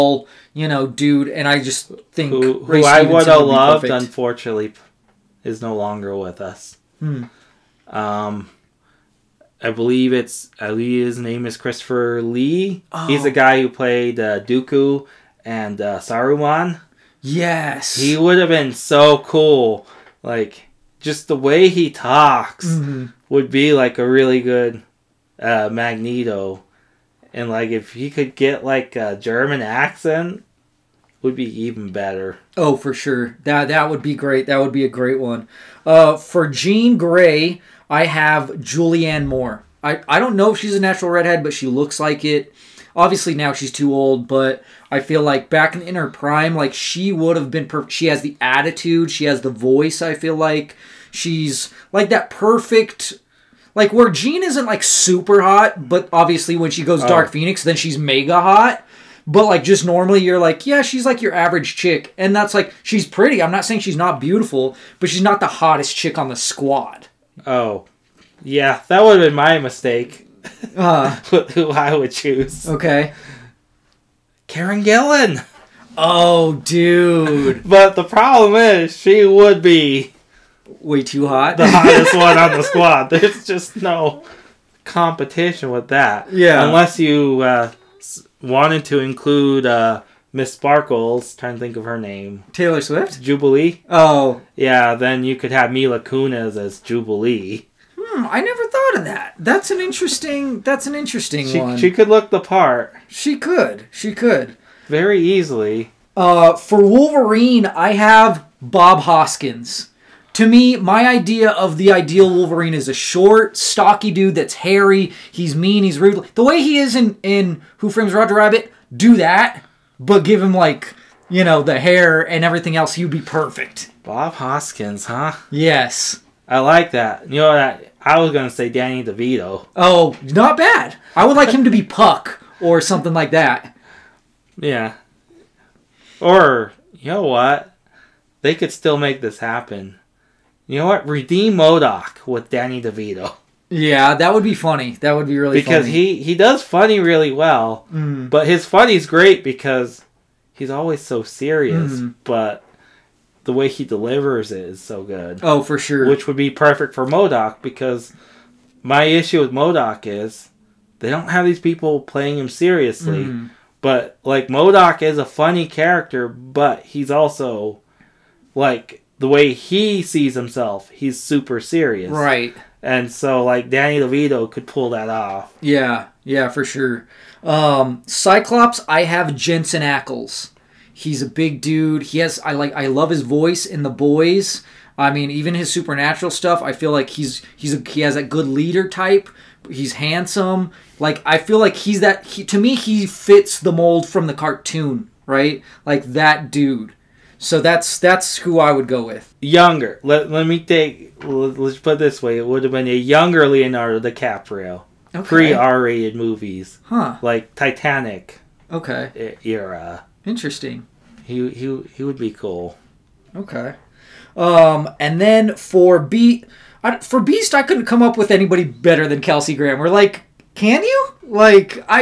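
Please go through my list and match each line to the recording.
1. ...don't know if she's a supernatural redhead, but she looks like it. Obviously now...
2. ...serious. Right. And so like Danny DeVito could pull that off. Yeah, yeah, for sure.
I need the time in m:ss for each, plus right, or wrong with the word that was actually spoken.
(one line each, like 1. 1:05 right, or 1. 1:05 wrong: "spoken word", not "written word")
1. 0:40 wrong: "natural", not "supernatural"
2. 2:51 right.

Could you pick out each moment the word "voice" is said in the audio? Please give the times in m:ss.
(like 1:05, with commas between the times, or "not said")
0:49, 3:03.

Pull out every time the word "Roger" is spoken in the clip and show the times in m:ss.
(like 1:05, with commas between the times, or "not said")
1:58.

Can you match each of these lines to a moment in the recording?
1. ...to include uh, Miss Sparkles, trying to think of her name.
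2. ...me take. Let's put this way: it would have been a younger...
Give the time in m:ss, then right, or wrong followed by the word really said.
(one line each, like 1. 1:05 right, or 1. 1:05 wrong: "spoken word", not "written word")
1. 1:28 right
2. 3:20 right.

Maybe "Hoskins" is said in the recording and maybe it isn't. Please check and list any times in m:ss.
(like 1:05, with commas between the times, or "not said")
1:49, 2:04.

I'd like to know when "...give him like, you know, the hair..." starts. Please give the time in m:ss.
2:00.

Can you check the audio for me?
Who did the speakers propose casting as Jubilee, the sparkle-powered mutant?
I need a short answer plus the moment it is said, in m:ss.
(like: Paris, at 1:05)
Mila Kunis, at 1:35.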